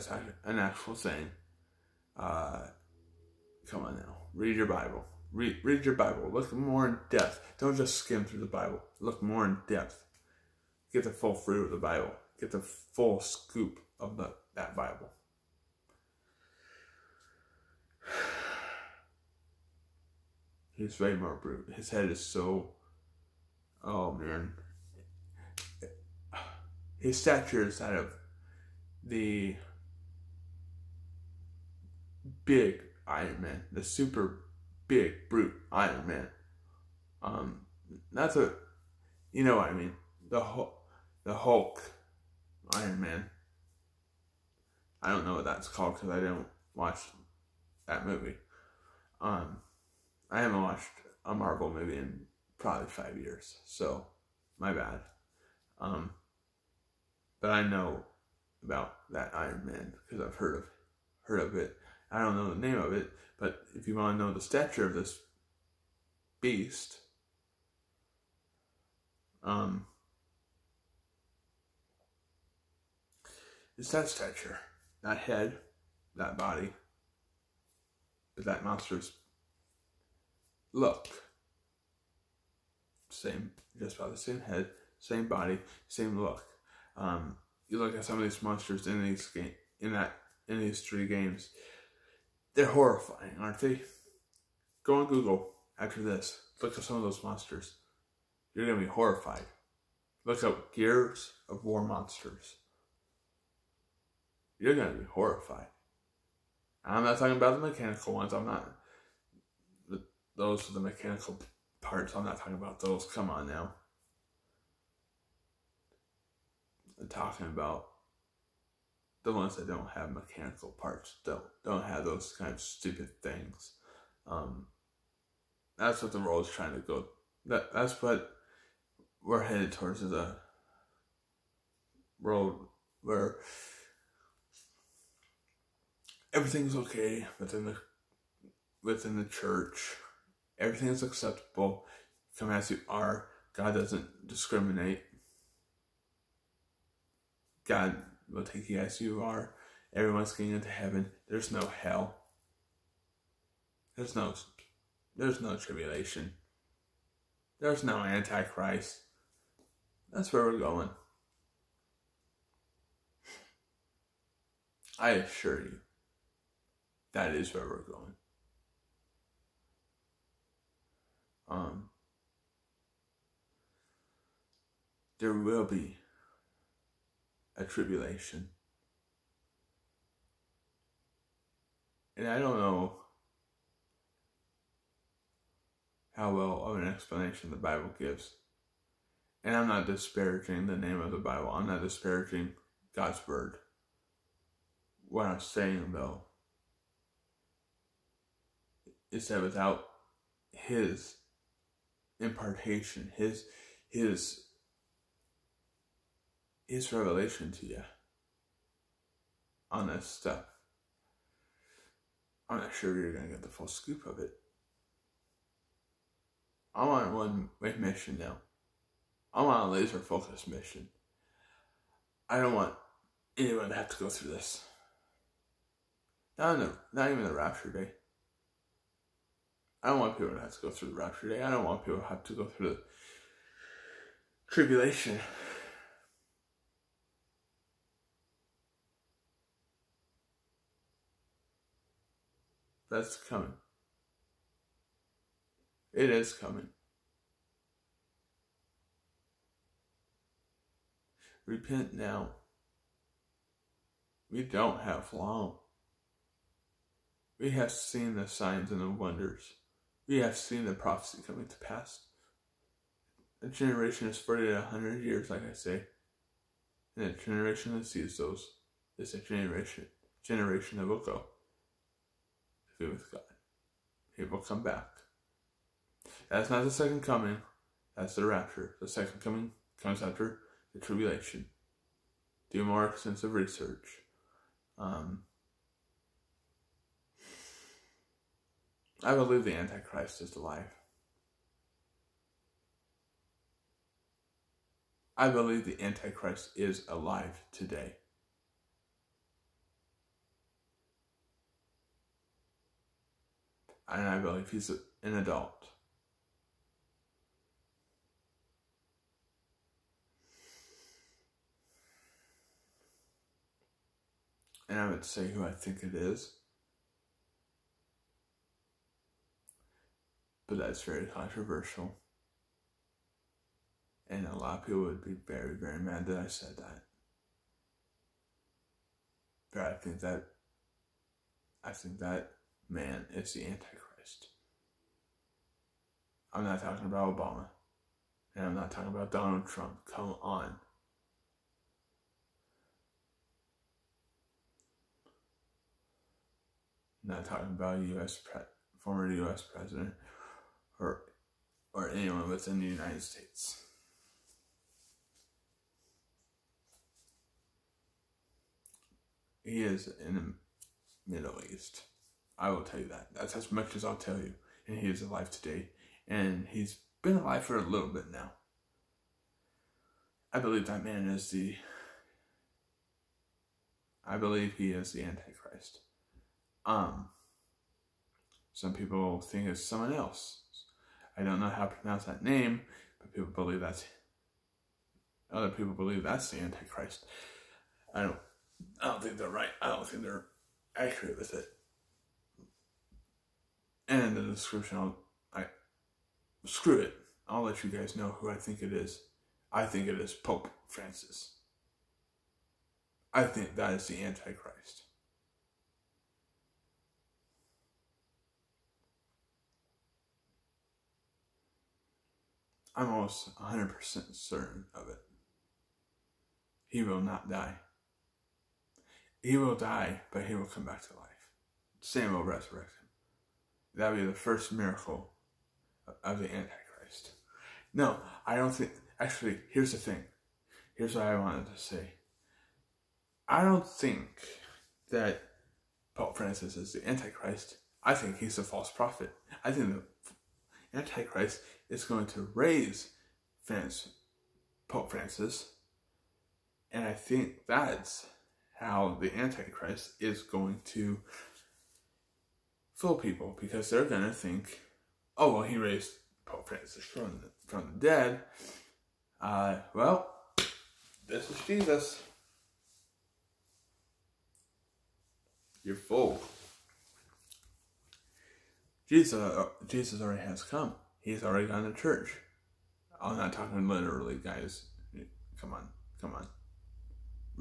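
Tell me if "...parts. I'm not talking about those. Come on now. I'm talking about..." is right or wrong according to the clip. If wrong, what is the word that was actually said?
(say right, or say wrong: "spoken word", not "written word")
right.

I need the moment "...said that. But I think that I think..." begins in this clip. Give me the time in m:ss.
5:26.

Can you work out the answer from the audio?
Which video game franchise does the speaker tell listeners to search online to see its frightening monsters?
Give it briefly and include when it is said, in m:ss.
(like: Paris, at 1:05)
Gears of War, at 1:40.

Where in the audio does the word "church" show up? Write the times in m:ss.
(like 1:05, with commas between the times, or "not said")
2:19, 7:51.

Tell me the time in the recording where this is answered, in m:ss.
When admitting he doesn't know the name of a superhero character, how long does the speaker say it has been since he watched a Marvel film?
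0:52.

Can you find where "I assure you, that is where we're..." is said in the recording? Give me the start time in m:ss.
2:45.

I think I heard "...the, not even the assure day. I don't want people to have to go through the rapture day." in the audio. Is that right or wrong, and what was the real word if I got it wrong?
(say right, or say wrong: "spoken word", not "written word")
wrong: "rapture", not "assure".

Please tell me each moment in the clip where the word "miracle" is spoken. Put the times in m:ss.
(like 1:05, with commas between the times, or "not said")
7:04.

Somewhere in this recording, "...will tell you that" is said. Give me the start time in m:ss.
6:02.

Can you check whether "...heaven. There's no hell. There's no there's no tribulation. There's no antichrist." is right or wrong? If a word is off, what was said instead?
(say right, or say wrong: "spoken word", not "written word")
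right.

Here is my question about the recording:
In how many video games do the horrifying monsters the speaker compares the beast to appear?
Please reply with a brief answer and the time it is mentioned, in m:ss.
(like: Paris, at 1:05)
3, at 1:30.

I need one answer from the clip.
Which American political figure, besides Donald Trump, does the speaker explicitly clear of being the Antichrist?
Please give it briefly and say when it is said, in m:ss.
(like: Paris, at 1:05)
Obama, at 5:37.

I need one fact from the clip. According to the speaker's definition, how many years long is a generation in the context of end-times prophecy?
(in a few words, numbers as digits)
40 to 100 years.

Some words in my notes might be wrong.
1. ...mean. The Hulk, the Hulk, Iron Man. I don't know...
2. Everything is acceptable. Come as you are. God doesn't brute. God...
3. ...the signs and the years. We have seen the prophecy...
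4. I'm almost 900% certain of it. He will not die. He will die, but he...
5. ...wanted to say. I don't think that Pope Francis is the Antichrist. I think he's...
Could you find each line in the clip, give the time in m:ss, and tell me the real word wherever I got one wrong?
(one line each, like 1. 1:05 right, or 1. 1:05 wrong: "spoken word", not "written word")
1. 0:39 right
2. 2:20 wrong: "discriminate", not "brute"
3. 4:18 wrong: "wonders", not "years"
4. 6:52 wrong: "100", not "900"
5. 7:11 right.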